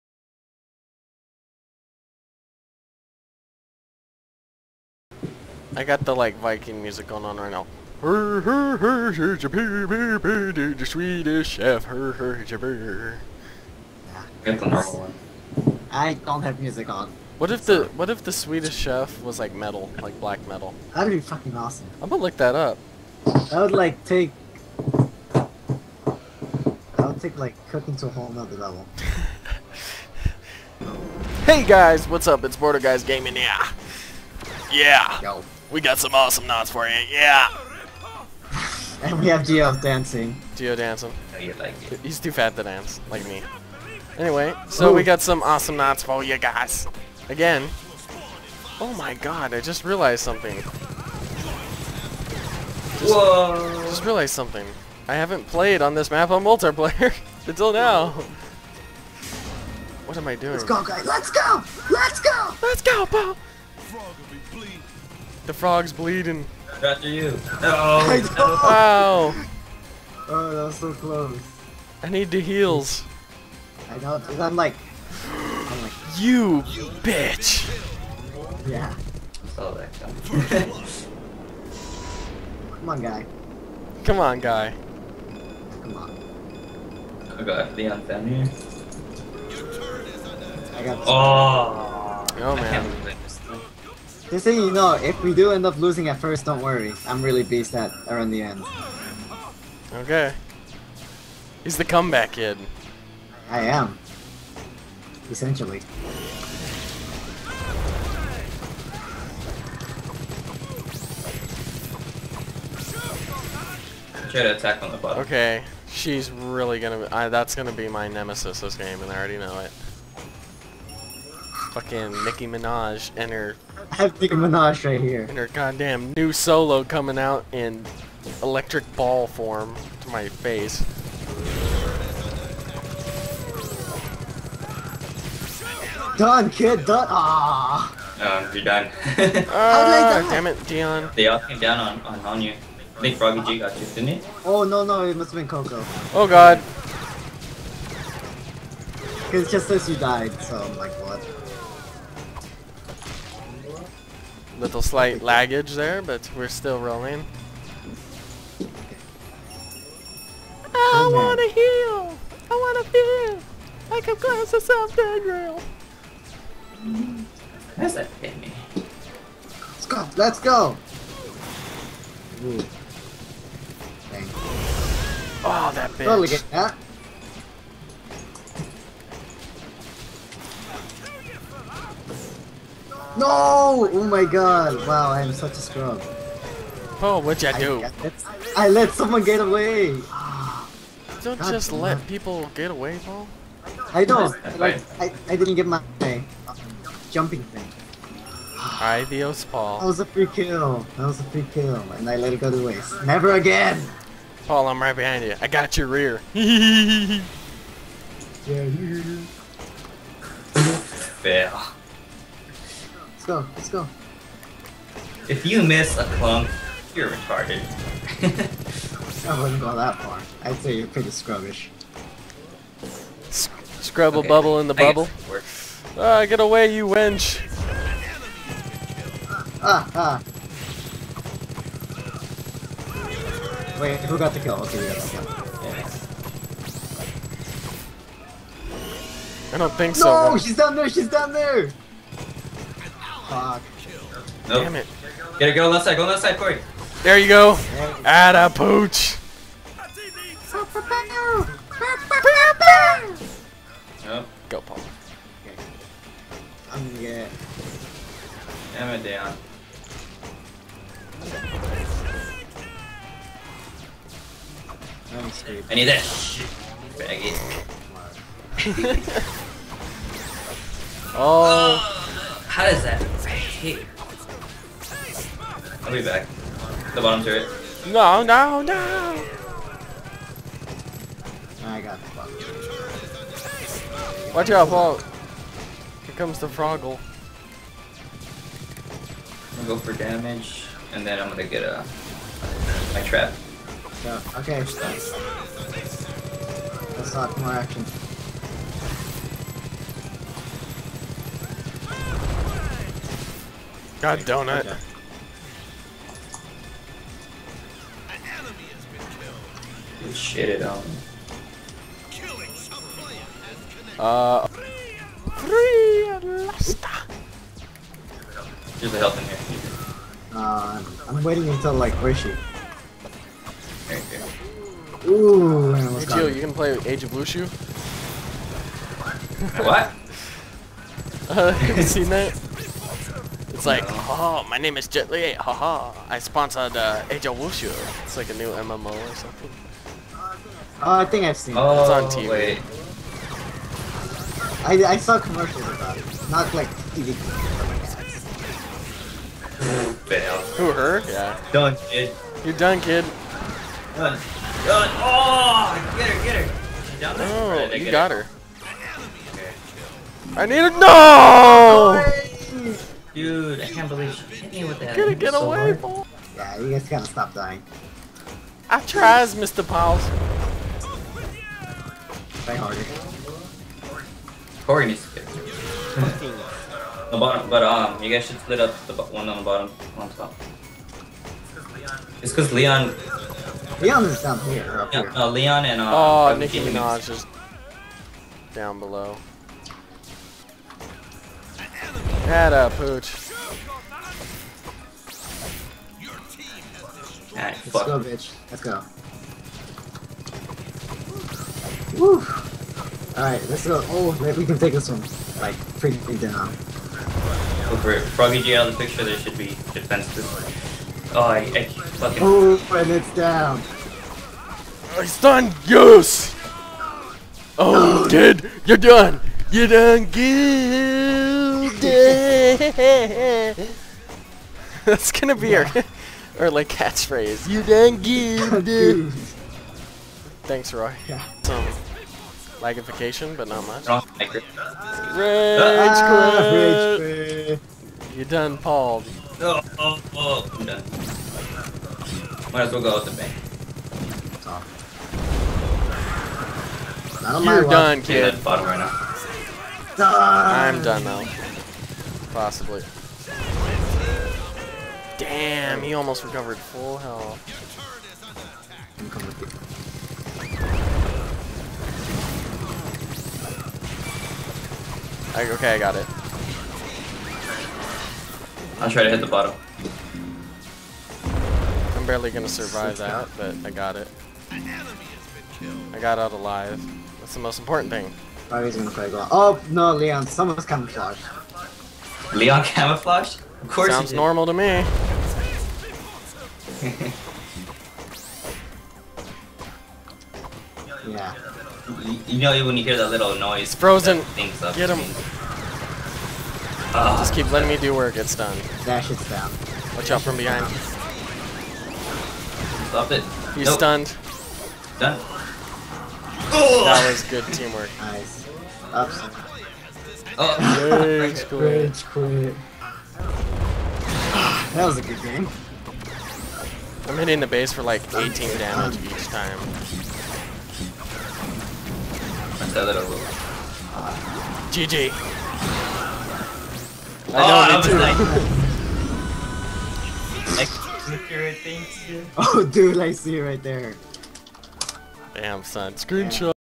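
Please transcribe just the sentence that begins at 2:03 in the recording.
I have Nicki Minaj right here.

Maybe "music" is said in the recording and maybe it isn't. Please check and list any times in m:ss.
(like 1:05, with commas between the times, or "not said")
0:06, 0:16.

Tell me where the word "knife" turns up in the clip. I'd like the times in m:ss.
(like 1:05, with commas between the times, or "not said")
not said.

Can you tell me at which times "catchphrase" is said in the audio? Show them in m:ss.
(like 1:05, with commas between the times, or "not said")
7:06.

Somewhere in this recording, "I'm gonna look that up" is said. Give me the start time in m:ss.
0:22.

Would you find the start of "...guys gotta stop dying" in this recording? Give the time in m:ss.
6:06.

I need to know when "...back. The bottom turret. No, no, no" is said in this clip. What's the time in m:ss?
4:36.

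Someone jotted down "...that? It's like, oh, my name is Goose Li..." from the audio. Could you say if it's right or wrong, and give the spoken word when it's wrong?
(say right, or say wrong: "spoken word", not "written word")
wrong: "Jet", not "Goose".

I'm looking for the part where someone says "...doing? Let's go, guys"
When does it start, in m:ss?
1:00.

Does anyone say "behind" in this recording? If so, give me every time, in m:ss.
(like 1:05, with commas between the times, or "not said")
3:24, 8:20.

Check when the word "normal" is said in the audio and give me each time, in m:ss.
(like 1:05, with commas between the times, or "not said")
0:14, 8:04.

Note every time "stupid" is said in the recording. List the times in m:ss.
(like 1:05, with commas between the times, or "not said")
4:25.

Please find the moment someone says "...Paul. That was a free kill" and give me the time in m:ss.
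3:19.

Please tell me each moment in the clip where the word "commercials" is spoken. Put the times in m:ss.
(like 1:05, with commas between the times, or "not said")
5:45.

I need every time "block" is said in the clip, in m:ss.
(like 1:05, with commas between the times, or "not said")
not said.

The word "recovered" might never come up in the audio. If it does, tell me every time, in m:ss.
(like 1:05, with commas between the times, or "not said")
7:36.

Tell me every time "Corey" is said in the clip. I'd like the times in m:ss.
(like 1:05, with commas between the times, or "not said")
4:06, 6:14.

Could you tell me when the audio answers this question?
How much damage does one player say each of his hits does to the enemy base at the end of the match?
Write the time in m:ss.
8:38.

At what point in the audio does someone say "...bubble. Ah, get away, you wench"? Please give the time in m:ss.
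3:44.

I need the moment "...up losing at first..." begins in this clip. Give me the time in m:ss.
1:35.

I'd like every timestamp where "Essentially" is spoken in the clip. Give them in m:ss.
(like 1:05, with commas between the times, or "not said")
1:45.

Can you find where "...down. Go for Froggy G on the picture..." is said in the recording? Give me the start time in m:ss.
6:46.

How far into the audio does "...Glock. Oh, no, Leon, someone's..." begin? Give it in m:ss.
7:59.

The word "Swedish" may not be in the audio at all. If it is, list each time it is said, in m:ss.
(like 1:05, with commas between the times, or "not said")
0:10, 0:18.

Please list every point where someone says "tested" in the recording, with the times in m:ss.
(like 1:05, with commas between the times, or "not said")
not said.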